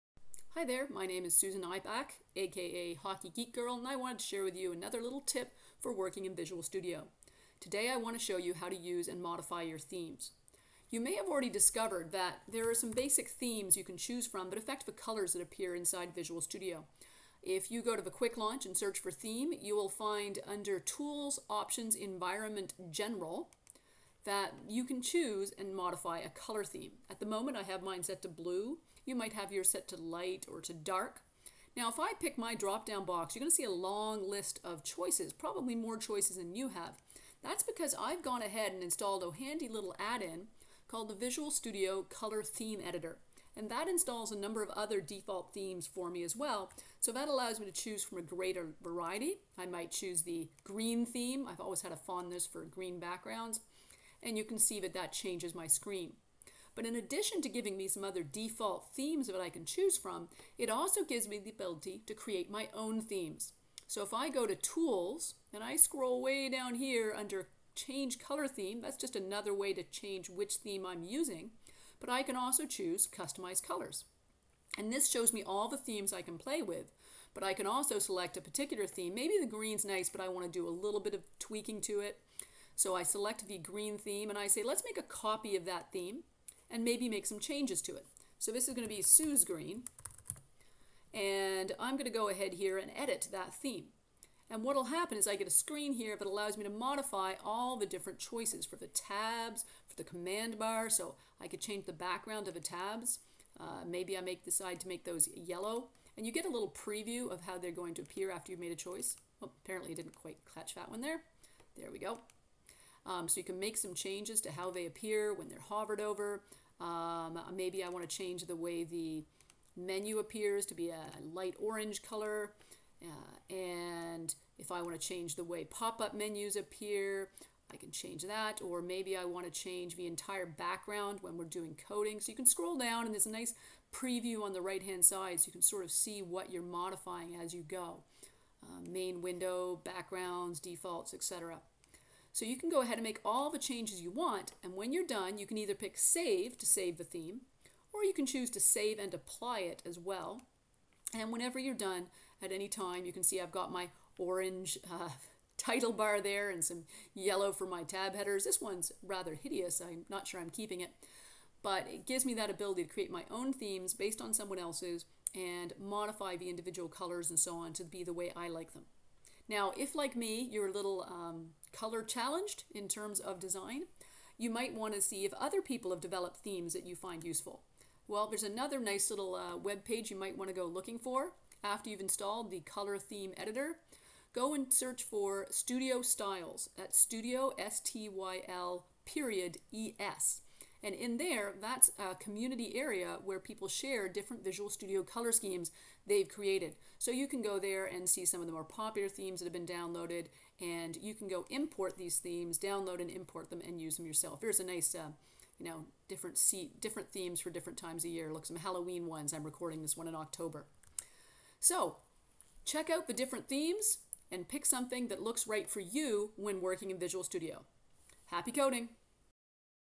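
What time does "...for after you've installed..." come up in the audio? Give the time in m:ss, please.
3:00.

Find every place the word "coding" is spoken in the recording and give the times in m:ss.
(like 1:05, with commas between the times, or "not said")
2:11, 3:38.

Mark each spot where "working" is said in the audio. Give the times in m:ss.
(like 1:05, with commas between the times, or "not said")
0:05, 3:36.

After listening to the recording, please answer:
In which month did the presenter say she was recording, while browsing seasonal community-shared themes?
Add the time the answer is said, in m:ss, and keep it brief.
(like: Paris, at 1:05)
October, at 3:30.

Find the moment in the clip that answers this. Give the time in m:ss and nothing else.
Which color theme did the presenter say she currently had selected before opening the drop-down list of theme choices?
0:28.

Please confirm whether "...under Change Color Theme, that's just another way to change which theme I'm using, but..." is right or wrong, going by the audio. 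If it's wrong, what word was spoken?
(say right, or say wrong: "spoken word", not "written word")
right.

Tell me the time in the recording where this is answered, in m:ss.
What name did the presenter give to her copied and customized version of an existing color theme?
1:29.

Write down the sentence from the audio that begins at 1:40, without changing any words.
So I could change the background of the tabs.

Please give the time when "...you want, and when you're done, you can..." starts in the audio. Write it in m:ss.
2:24.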